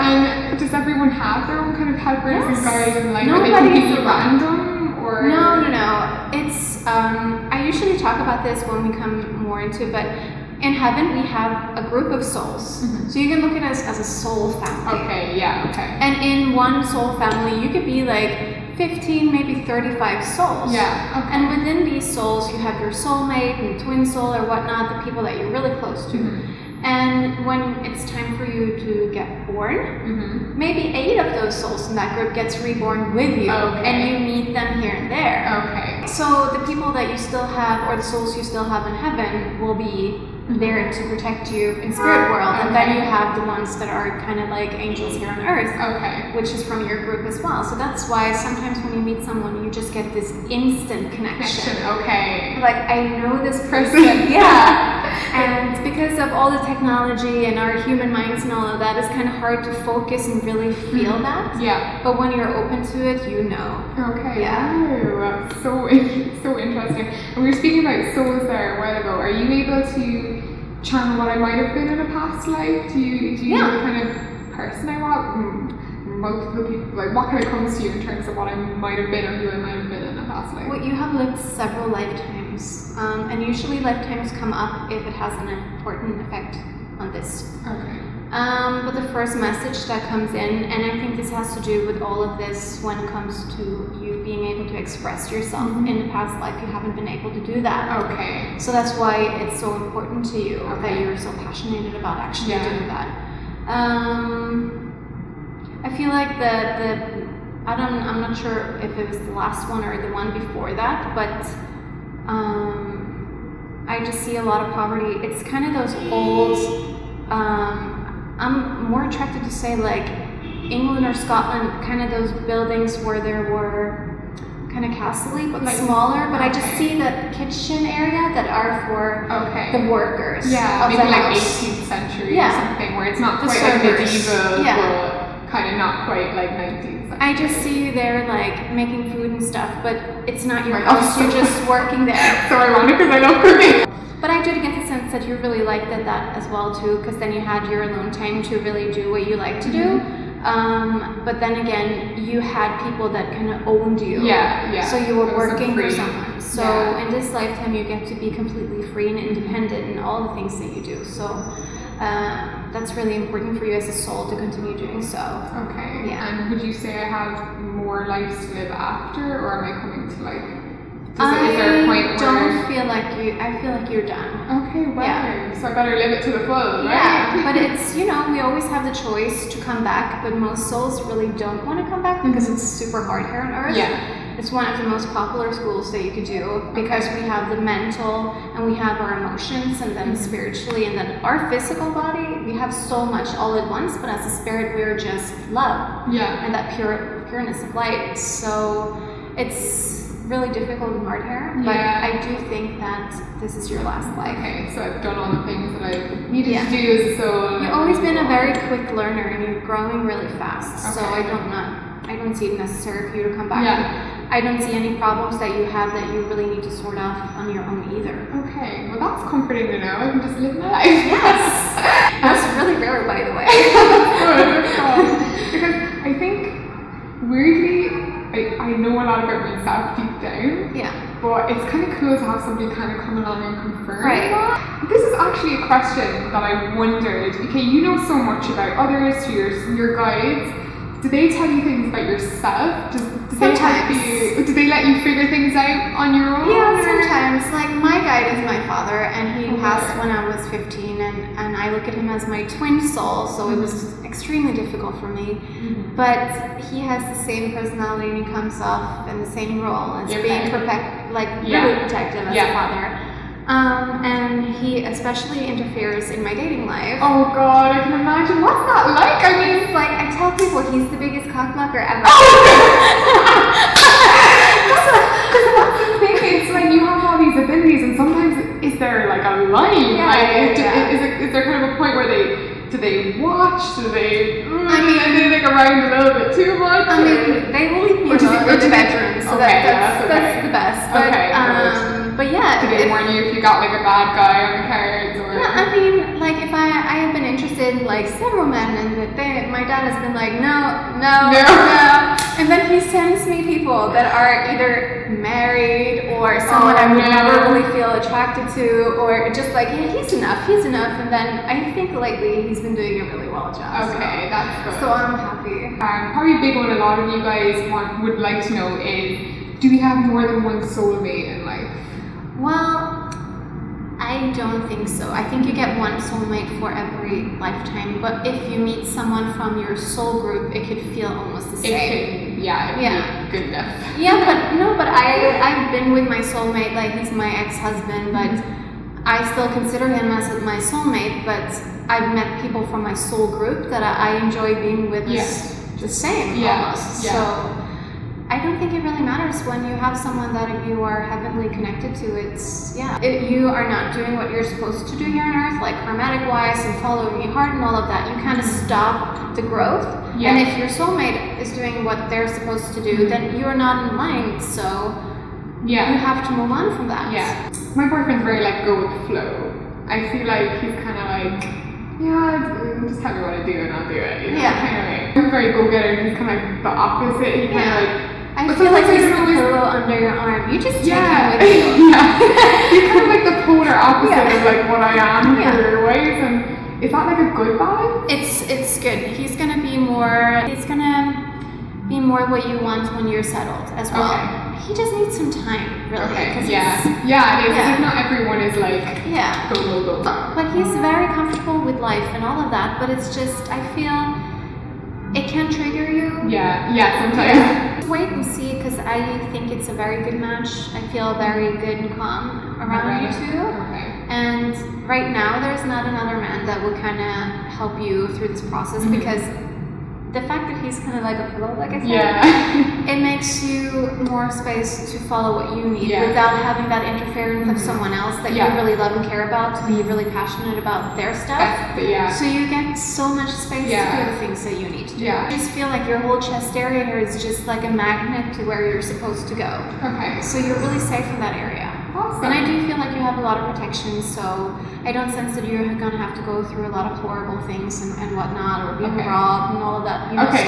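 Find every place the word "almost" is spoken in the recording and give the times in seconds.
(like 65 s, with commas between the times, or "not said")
331 s, 346 s.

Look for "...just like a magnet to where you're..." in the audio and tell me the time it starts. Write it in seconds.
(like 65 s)
437 s.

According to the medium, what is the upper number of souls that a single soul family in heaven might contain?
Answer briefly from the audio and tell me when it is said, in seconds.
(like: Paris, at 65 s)
35, at 19 s.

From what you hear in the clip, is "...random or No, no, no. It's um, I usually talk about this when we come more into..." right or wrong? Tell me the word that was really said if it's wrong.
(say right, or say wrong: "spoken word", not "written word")
right.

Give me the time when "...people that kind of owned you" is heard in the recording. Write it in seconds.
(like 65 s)
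152 s.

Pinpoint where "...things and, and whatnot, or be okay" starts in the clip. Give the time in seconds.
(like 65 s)
447 s.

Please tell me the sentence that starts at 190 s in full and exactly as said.
spiritually and then our physical body.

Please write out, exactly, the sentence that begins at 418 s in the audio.
because the fact that he's kind of like a pillow, like I said, yeah.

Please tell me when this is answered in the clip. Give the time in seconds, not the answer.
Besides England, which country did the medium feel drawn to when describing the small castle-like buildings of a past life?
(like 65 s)
121 s.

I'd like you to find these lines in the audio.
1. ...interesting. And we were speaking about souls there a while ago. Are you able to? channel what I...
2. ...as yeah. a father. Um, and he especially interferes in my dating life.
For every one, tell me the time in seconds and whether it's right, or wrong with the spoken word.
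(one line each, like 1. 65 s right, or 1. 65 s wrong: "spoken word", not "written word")
1. 66 s right
2. 262 s right.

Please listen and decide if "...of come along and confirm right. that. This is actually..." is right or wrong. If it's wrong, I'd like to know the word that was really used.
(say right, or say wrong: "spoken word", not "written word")
right.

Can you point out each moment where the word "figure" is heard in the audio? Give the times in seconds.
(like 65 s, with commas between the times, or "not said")
245 s.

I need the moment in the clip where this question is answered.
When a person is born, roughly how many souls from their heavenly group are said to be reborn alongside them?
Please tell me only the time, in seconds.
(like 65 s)
30 s.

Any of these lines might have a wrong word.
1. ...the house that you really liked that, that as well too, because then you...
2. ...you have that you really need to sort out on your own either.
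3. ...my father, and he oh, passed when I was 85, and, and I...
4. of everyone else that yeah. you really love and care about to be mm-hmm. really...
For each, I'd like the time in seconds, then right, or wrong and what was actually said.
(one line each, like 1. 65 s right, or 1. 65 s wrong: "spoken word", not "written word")
1. 144 s wrong: "sense", not "house"
2. 215 s right
3. 248 s wrong: "15", not "85"
4. 427 s wrong: "someone", not "everyone".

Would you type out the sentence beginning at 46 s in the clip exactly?
which is from your group as well.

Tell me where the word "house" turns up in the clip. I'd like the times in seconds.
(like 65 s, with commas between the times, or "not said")
131 s, 140 s.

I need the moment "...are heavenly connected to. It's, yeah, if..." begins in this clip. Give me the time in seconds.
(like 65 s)
350 s.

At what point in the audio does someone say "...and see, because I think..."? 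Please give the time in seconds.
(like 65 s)
408 s.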